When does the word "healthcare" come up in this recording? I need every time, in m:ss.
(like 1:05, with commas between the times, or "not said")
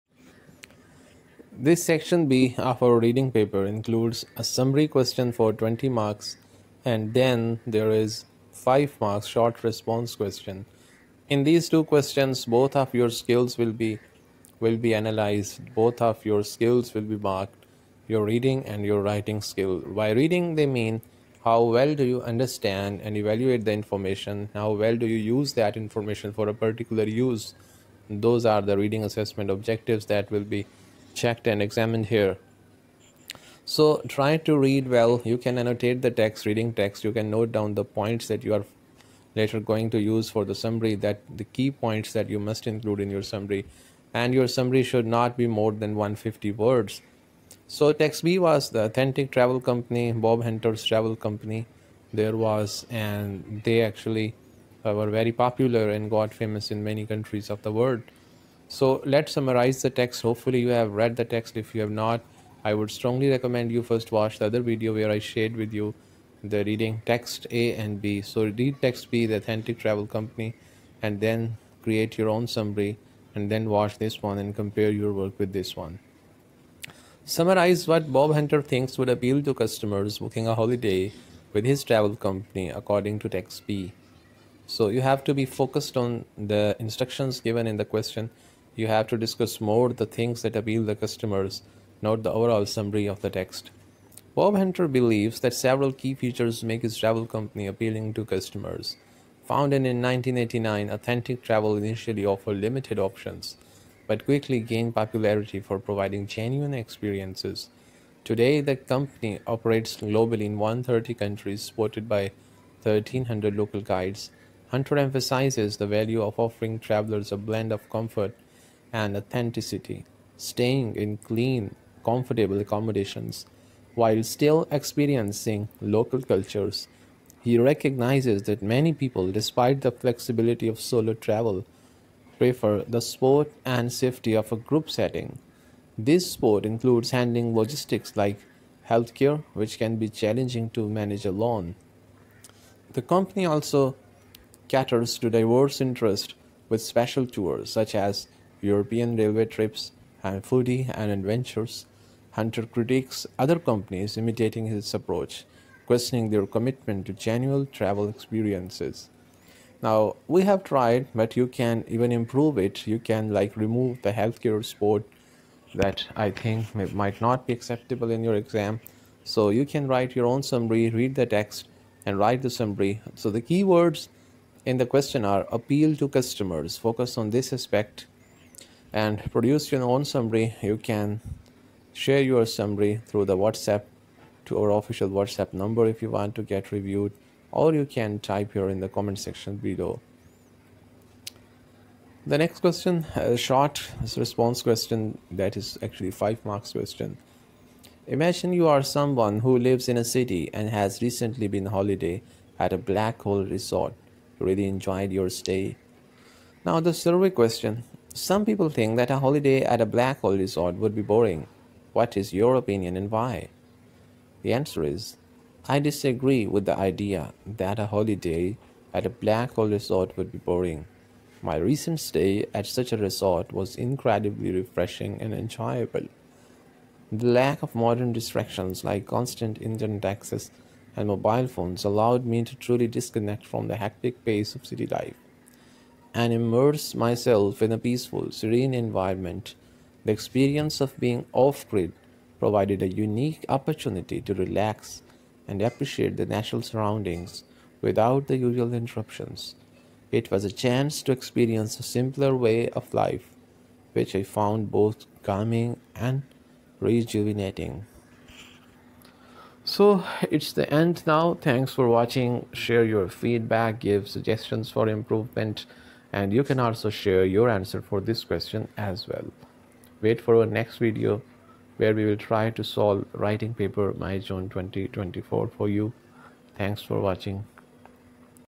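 2:18, 2:44.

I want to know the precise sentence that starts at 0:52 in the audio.
There was, and they actually were very popular and got famous in many countries of the world.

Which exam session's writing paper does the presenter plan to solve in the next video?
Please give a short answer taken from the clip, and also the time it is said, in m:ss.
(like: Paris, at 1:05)
May June 2024, at 4:33.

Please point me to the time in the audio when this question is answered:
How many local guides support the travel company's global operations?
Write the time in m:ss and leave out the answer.
1:52.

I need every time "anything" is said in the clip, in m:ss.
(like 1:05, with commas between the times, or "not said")
not said.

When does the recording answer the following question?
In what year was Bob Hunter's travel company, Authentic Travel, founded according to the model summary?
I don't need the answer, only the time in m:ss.
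1:40.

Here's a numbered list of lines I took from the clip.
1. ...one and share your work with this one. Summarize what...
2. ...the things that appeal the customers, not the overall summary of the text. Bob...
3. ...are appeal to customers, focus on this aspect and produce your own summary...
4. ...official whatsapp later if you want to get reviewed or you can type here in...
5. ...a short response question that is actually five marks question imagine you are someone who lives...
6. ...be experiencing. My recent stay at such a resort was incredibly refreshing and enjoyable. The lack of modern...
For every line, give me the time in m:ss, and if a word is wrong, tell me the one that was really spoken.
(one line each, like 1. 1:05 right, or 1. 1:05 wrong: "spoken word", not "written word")
1. 1:14 wrong: "compare", not "share"
2. 1:29 right
3. 2:55 right
4. 3:04 wrong: "number", not "later"
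5. 3:13 right
6. 3:40 wrong: "boring", not "experiencing".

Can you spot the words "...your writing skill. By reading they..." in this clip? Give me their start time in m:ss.
0:18.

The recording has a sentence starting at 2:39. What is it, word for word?
Now, we have tried, but you can even improve it.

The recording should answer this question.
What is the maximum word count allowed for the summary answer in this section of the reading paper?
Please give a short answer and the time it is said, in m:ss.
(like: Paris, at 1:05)
150 words, at 0:45.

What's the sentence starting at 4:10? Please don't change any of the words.
It was a chance to experience a simpler way of life, which I found both calming and rejuvenating.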